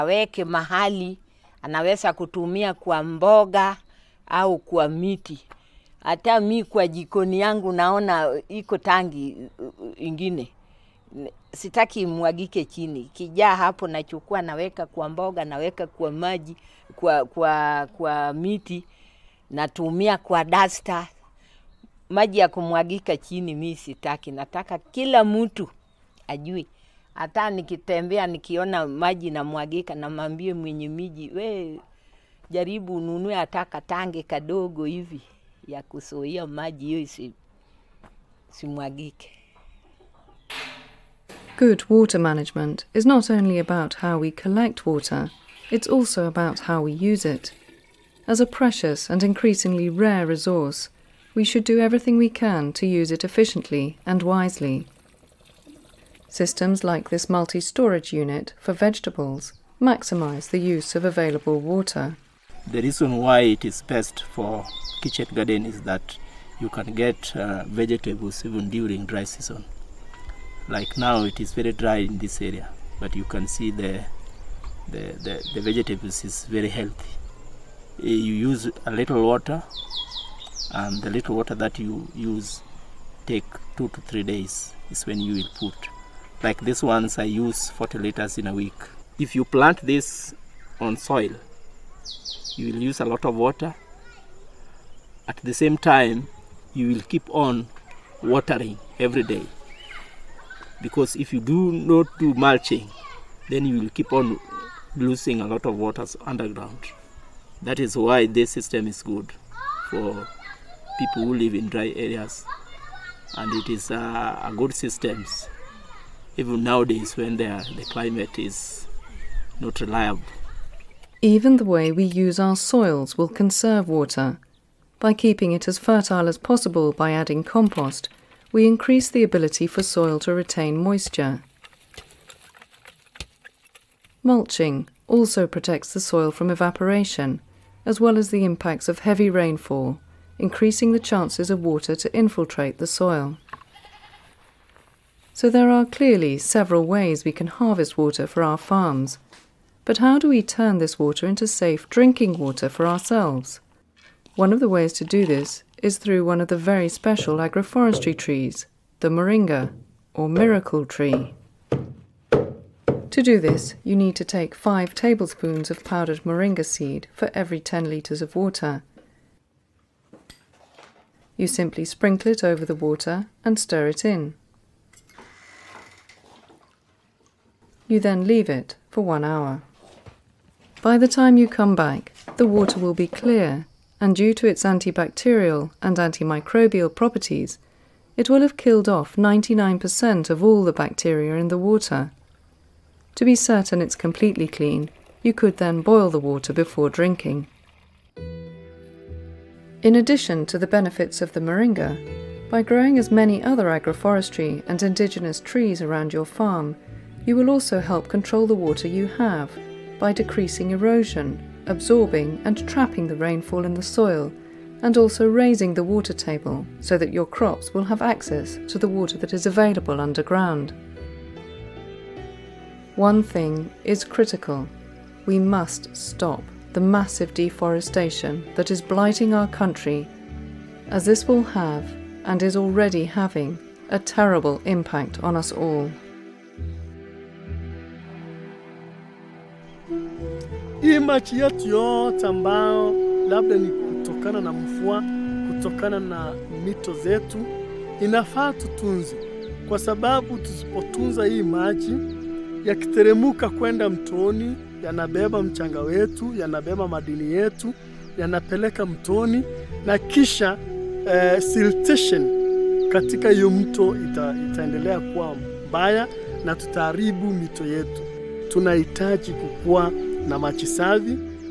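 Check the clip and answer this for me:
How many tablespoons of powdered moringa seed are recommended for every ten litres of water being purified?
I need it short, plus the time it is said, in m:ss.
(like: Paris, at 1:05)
5, at 2:44.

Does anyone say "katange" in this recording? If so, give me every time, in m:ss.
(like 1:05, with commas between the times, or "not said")
0:33.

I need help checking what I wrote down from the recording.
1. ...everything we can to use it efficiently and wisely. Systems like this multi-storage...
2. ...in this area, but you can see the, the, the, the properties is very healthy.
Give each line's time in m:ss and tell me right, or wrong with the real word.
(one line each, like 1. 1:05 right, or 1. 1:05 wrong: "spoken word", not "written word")
1. 0:51 right
2. 1:11 wrong: "vegetables", not "properties".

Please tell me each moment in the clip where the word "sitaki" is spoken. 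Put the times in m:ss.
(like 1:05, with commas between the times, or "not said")
0:11, 0:23.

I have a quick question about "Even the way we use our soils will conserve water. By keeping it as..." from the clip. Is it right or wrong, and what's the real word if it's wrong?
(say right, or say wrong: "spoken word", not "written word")
right.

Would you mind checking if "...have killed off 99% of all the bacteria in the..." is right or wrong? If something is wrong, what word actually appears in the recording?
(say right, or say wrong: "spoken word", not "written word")
right.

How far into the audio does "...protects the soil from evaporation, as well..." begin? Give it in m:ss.
2:15.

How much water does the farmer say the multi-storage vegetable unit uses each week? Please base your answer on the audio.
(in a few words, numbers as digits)
40 liters.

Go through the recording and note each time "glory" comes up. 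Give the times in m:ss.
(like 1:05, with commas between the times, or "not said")
not said.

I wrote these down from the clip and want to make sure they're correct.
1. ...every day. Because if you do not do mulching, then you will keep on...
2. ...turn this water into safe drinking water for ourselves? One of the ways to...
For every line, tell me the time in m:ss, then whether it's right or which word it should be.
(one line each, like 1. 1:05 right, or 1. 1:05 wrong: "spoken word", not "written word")
1. 1:38 right
2. 2:30 right.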